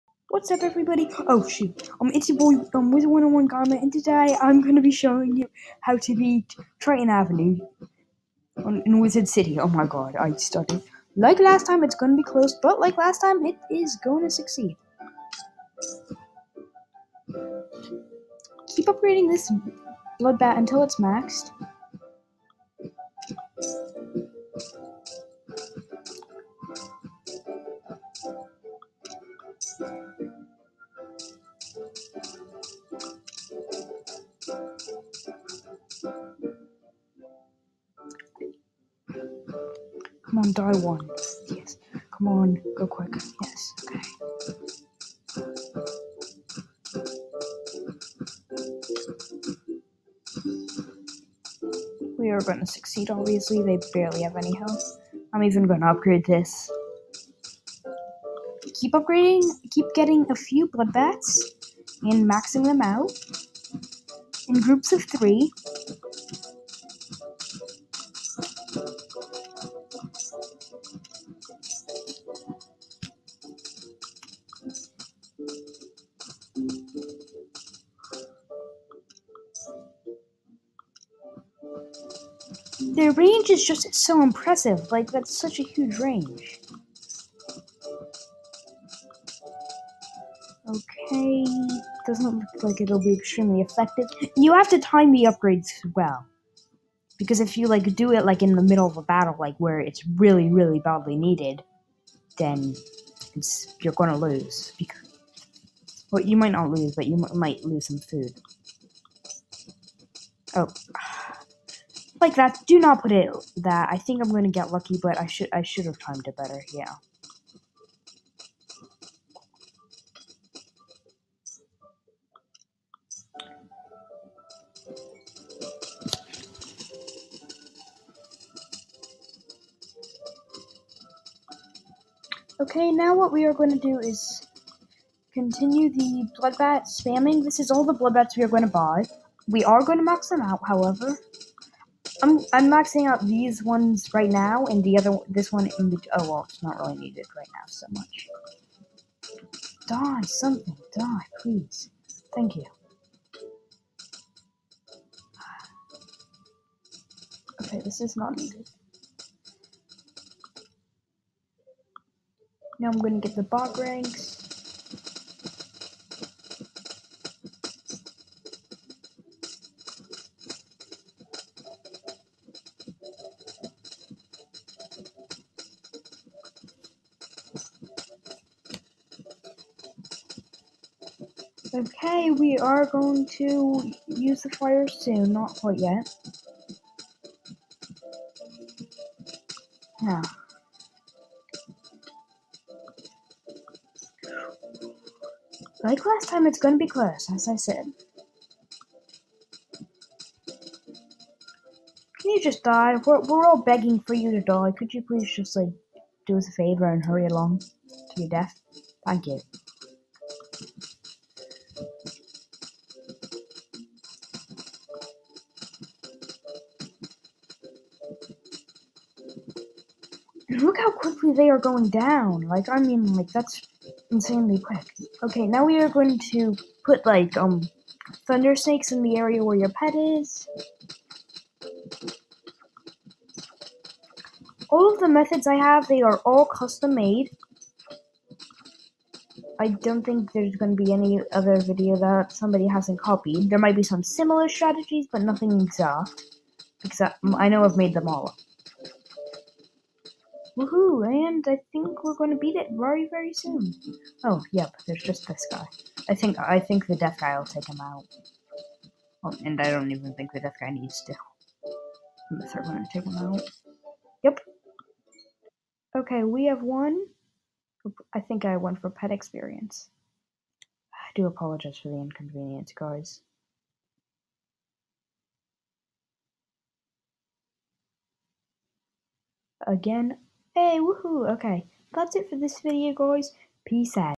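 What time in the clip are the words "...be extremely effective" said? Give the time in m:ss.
1:32.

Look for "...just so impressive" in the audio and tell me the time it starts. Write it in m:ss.
1:23.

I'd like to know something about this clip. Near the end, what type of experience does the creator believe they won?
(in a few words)
Pet experience.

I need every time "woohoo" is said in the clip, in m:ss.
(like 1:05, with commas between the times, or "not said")
4:10, 4:40.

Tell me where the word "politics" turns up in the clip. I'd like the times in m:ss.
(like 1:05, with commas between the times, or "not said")
not said.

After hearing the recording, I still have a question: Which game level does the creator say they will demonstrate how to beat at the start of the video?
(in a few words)
Triton Avenue.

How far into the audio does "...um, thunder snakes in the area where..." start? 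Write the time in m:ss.
3:47.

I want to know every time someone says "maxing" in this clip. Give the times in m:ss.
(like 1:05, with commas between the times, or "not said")
1:02, 2:22.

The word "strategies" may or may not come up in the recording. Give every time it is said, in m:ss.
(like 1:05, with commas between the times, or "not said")
4:04.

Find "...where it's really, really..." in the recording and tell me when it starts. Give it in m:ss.
1:39.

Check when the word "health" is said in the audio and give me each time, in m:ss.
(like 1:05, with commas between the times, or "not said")
0:54.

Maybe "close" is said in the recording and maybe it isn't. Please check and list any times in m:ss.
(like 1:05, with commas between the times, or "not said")
0:12, 3:16.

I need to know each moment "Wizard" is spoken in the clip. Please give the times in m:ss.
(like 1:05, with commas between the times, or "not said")
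0:02, 0:09.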